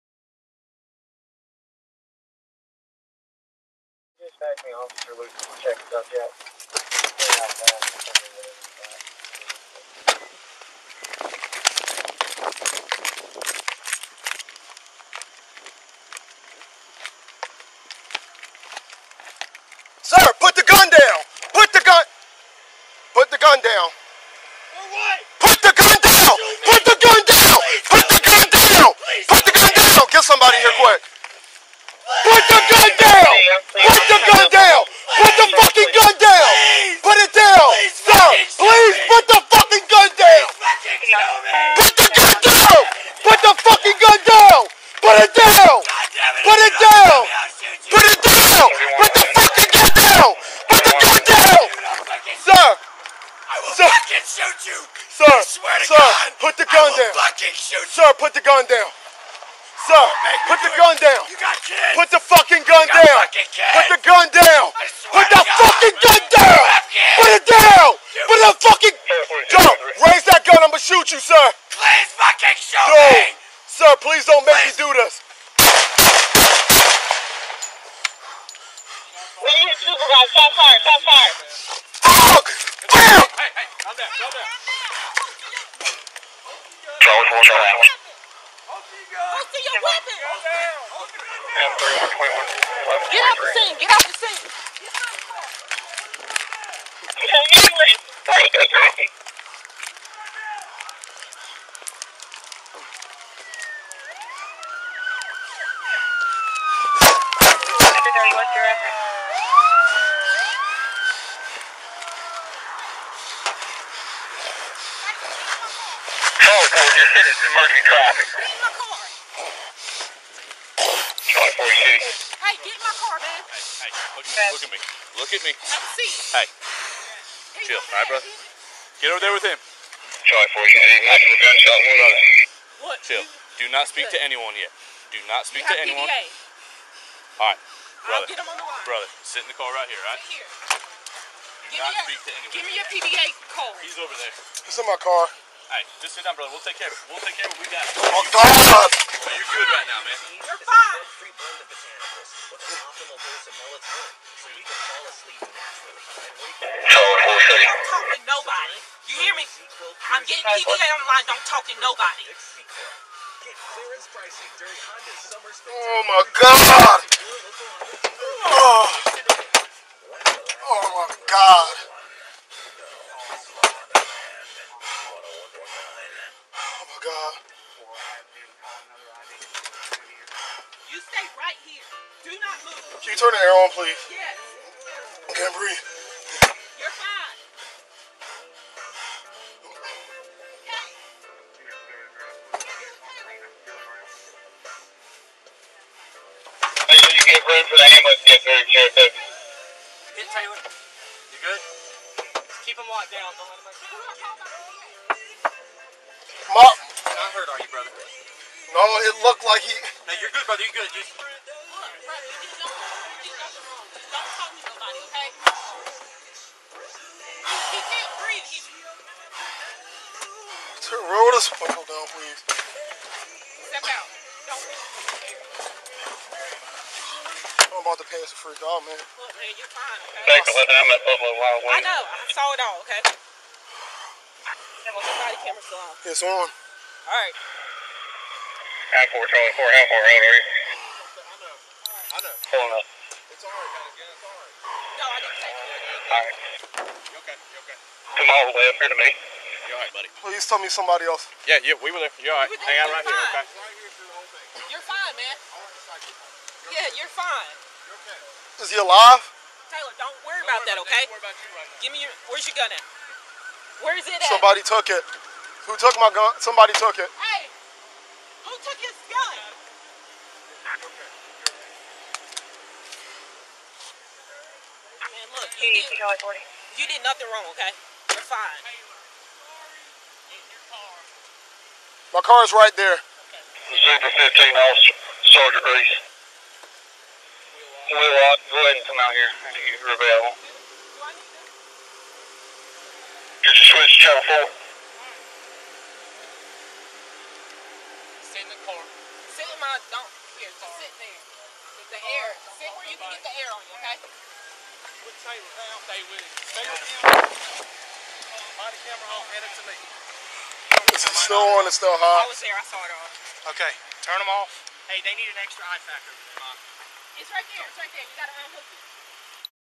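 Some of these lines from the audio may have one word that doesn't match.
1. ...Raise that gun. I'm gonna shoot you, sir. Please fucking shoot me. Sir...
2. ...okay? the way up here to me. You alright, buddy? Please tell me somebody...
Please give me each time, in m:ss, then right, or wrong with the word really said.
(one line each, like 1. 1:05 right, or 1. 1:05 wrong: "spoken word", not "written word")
1. 1:10 right
2. 4:07 right.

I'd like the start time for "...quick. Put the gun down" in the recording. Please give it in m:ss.
0:30.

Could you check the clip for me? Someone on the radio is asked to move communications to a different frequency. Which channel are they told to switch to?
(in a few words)
Channel 4.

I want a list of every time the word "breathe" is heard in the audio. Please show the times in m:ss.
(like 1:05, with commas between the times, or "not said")
3:05.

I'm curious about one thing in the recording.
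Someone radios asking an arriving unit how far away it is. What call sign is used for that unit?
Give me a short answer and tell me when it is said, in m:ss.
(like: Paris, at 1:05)
Charlie 4, at 3:59.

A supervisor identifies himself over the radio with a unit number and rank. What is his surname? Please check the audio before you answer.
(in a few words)
Reese.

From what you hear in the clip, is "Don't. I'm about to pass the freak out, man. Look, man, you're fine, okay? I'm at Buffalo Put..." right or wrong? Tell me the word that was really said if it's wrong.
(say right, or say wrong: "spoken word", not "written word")
wrong: "Wild", not "Put".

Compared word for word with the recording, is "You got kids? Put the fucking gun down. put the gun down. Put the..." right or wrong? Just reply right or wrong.
right.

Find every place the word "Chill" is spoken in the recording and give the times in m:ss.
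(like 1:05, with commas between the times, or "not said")
2:07, 2:13.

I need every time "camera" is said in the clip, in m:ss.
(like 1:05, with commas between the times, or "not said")
3:55, 5:08.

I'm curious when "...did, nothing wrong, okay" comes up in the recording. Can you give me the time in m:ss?
4:36.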